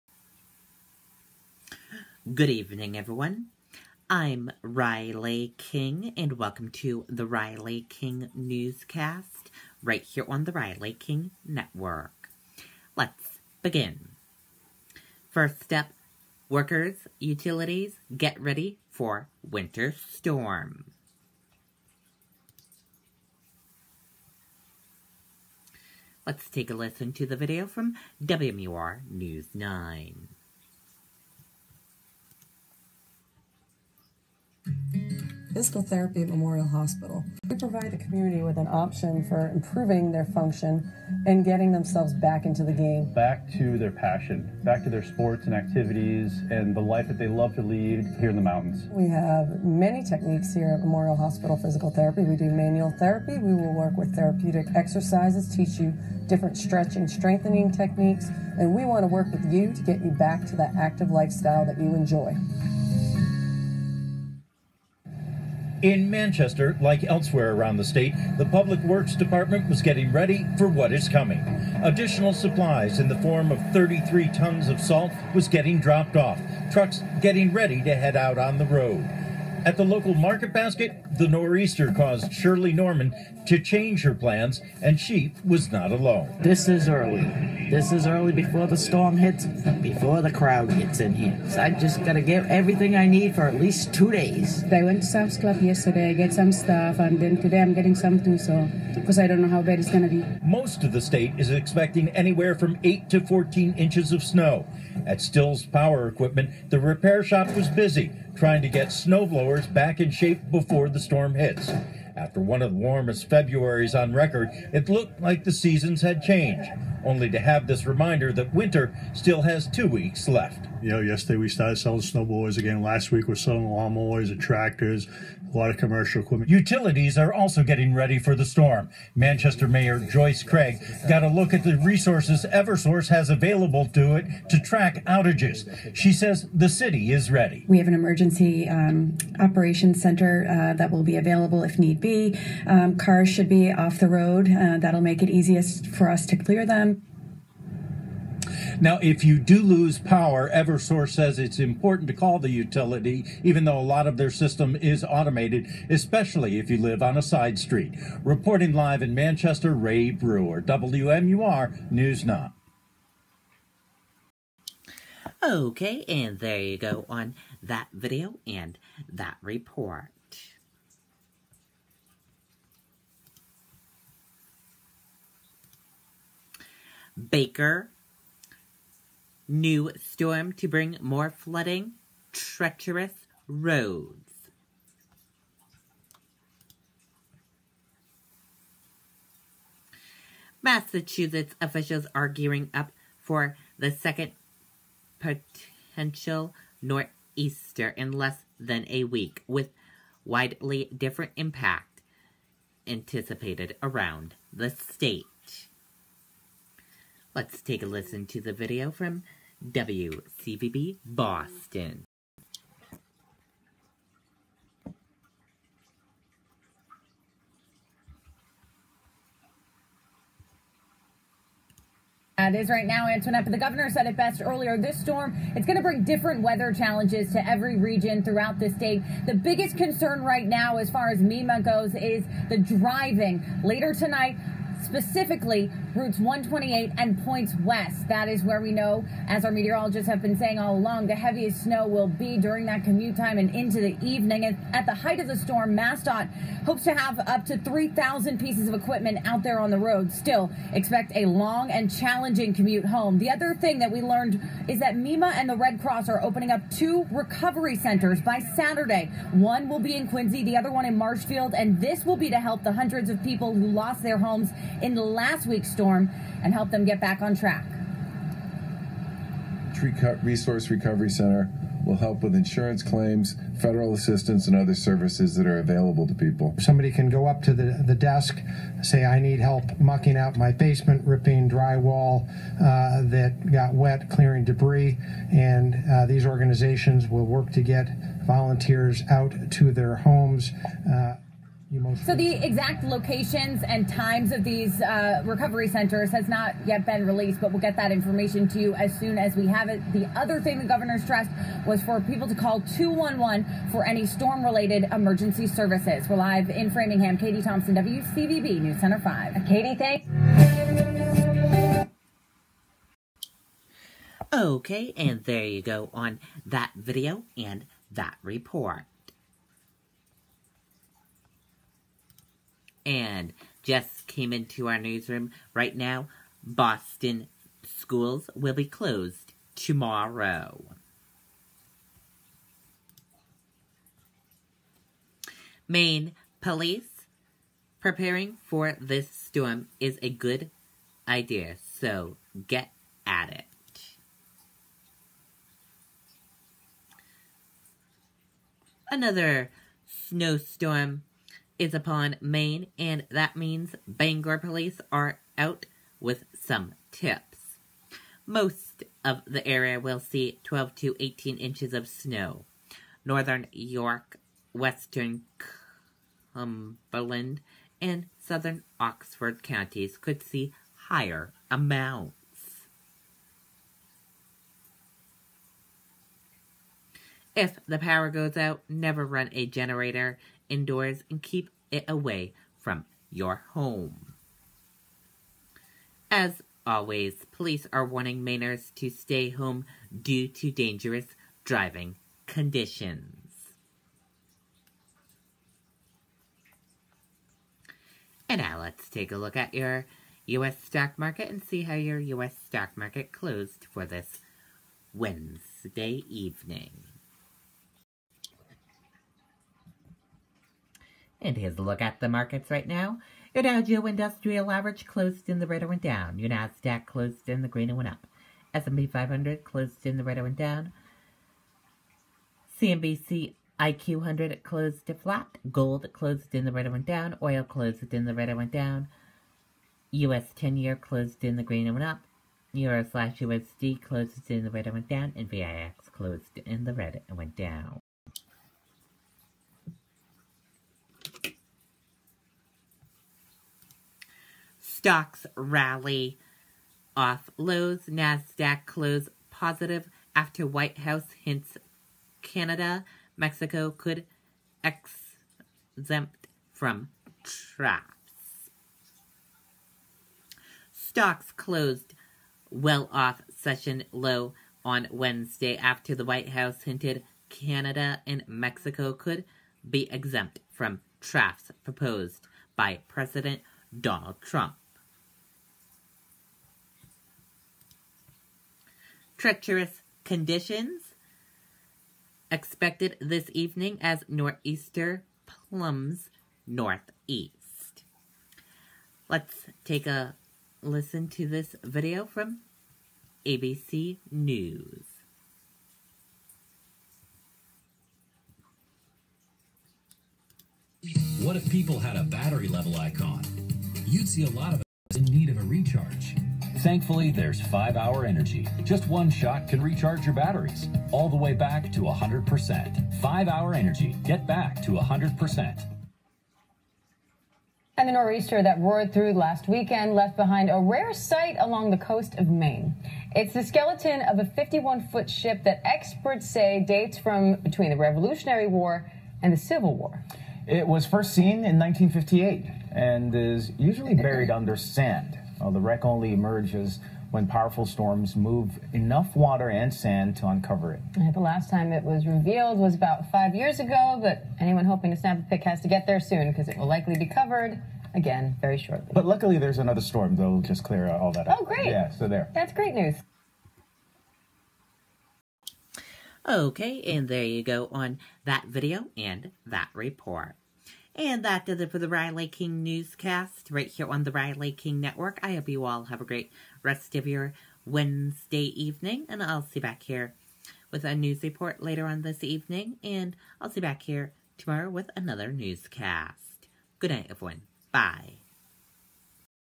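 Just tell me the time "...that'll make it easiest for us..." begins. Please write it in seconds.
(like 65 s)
144 s.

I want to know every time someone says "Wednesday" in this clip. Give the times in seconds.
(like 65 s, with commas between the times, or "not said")
404 s, 464 s, 567 s.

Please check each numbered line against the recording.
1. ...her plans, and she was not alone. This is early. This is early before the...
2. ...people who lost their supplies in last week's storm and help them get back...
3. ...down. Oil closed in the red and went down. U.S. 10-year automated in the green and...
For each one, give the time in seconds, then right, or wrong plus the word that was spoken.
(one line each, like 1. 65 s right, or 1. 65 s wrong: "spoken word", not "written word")
1. 84 s right
2. 263 s wrong: "homes", not "supplies"
3. 426 s wrong: "closed", not "automated".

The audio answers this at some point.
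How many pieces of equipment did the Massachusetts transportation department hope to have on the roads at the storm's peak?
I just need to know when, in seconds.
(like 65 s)
247 s.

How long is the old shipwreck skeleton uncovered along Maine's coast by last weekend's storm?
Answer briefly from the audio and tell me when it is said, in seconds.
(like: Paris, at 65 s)
51 feet, at 524 s.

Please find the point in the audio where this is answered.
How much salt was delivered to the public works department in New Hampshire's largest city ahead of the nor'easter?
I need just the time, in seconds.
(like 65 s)
73 s.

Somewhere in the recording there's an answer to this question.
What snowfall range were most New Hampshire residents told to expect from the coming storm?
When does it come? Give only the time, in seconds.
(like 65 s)
102 s.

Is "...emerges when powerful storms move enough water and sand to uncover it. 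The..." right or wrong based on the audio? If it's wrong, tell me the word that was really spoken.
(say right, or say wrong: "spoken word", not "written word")
right.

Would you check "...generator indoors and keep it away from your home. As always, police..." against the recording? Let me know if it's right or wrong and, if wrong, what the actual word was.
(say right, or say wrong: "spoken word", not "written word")
right.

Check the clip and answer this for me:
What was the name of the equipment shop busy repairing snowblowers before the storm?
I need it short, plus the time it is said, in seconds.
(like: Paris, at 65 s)
Still's Power Equipment, at 105 s.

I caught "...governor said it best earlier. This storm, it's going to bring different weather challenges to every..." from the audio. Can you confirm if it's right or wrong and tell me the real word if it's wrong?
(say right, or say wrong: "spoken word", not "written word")
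right.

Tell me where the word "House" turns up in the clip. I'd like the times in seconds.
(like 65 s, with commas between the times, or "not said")
450 s, 466 s.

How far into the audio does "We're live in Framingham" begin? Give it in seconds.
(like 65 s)
306 s.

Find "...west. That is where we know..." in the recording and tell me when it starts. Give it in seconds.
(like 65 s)
237 s.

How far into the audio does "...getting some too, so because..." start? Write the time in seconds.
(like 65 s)
97 s.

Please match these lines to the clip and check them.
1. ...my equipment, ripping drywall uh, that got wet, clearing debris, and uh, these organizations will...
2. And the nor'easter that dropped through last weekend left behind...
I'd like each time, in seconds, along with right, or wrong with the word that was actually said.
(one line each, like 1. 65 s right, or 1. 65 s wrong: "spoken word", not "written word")
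1. 280 s wrong: "basement", not "equipment"
2. 517 s wrong: "roared", not "dropped".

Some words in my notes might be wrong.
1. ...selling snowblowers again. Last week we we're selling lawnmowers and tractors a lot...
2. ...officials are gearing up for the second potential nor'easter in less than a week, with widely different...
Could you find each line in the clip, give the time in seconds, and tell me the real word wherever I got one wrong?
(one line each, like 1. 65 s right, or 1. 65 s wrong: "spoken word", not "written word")
1. 121 s right
2. 191 s right.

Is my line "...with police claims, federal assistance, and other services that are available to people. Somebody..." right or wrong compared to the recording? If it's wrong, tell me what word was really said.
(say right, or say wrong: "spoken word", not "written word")
wrong: "insurance", not "police".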